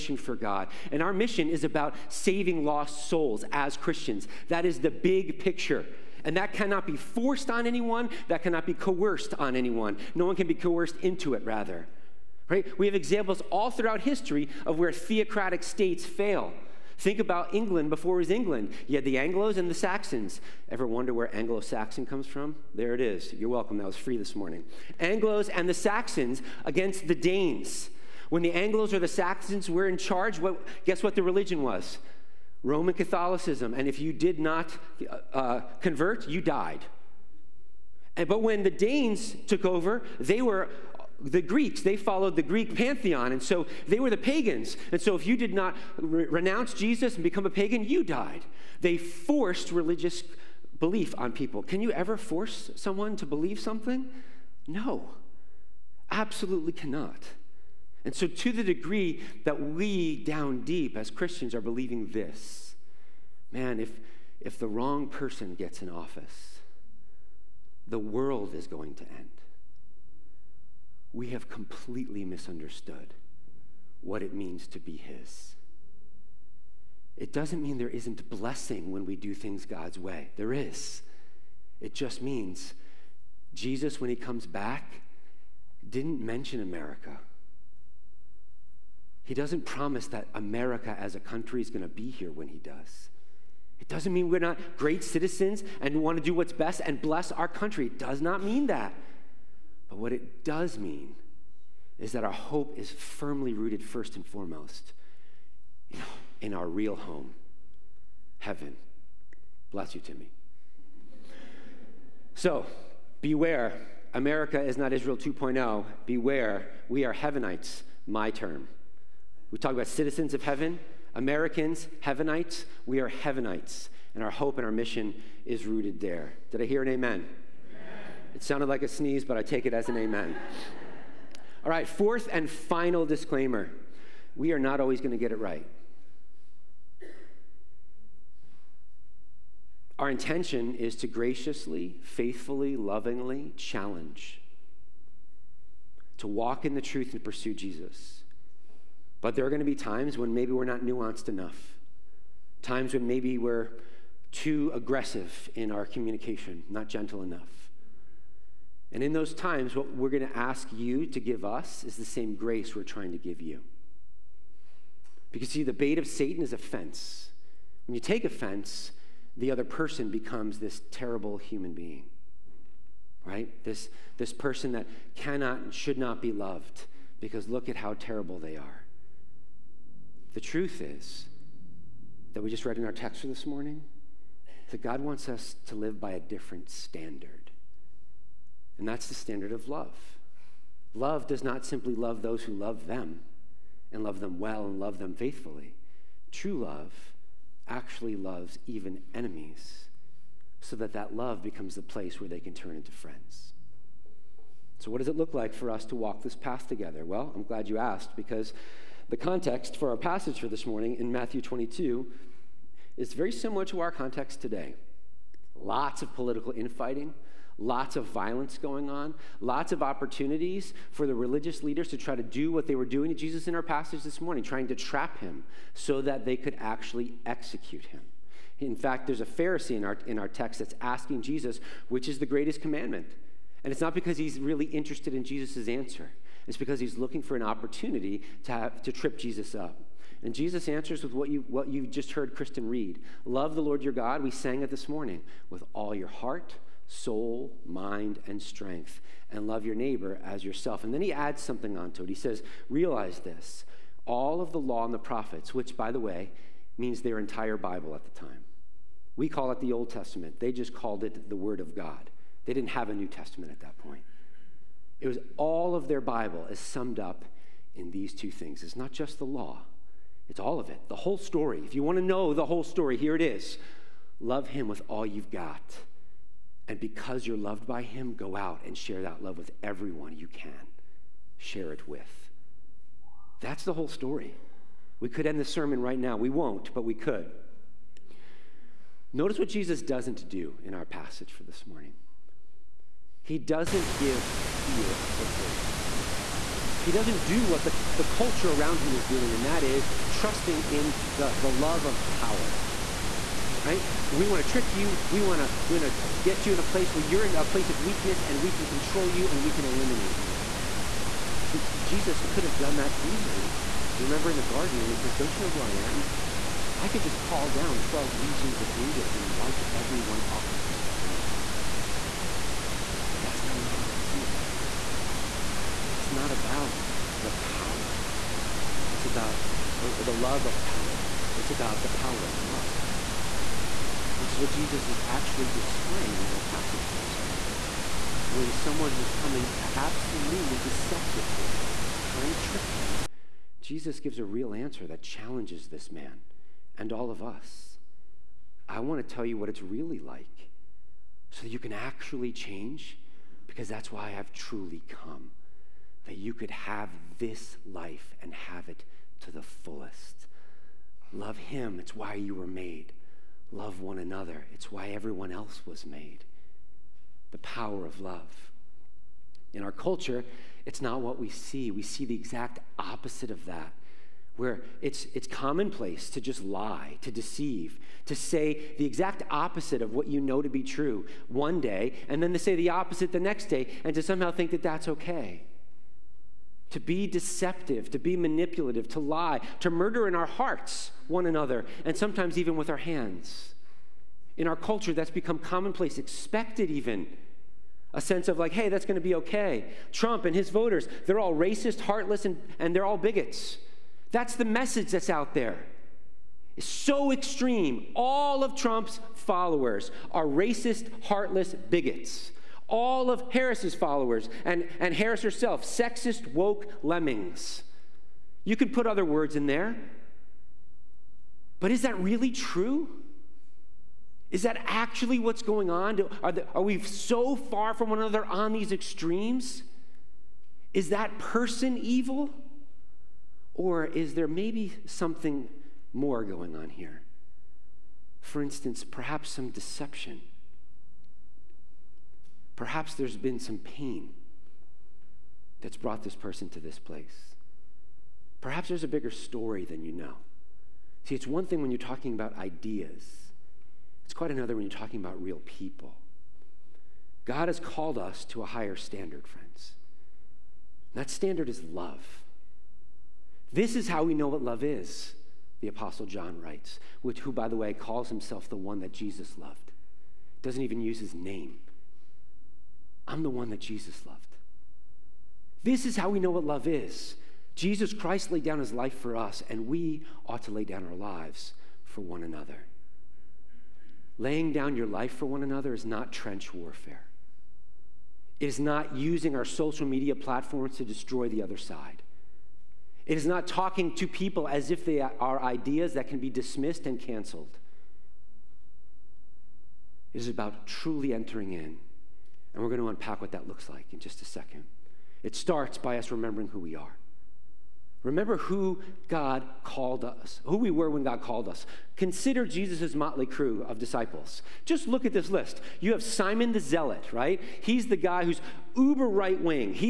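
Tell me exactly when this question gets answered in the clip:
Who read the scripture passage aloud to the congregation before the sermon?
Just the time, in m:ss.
4:02.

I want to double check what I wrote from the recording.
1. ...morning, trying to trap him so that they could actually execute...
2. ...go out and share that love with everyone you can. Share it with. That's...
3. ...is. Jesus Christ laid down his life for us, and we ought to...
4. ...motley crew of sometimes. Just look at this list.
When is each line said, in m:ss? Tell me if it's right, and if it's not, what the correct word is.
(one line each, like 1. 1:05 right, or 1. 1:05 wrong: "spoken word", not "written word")
1. 3:44 right
2. 4:38 right
3. 7:56 right
4. 8:32 wrong: "disciples", not "sometimes".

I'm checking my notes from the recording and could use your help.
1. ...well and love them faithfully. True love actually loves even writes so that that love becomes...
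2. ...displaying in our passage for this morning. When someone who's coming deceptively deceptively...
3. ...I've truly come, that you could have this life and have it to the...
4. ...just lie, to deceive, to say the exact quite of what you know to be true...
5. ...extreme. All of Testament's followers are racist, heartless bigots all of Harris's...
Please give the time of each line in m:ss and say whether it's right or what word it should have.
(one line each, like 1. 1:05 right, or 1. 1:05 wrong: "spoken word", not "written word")
1. 3:14 wrong: "enemies", not "writes"
2. 5:35 wrong: "absolutely", not "deceptively"
3. 5:54 right
4. 6:16 wrong: "opposite", not "quite"
5. 6:47 wrong: "Trump", not "Testament".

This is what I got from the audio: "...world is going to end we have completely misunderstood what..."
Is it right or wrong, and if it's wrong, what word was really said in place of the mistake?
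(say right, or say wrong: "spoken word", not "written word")
right.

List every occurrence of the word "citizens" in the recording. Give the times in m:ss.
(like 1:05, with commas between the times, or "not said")
1:35, 1:59.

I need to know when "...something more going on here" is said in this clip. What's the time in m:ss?
7:14.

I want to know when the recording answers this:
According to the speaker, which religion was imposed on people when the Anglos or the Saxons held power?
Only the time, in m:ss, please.
0:32.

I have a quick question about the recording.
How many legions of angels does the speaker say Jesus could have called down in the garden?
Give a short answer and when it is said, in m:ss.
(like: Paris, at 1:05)
12, at 5:17.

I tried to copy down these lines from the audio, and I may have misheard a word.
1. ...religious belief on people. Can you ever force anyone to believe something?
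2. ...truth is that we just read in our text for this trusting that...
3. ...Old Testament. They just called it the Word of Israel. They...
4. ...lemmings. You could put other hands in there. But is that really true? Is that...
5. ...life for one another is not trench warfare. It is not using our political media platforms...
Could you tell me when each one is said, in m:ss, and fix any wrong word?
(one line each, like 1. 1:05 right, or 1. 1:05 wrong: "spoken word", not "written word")
1. 0:49 wrong: "someone", not "anyone"
2. 3:00 wrong: "morning", not "trusting"
3. 4:19 wrong: "God", not "Israel"
4. 6:56 wrong: "words", not "hands"
5. 8:04 wrong: "social", not "political".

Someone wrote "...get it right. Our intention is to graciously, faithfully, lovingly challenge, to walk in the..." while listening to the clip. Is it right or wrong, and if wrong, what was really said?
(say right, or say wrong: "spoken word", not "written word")
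right.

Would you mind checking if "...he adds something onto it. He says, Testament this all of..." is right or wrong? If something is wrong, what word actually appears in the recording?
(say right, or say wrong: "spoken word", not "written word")
wrong: "Realize", not "Testament".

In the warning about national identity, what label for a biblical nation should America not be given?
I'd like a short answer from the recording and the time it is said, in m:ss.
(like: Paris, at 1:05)
Israel 2.0, at 1:54.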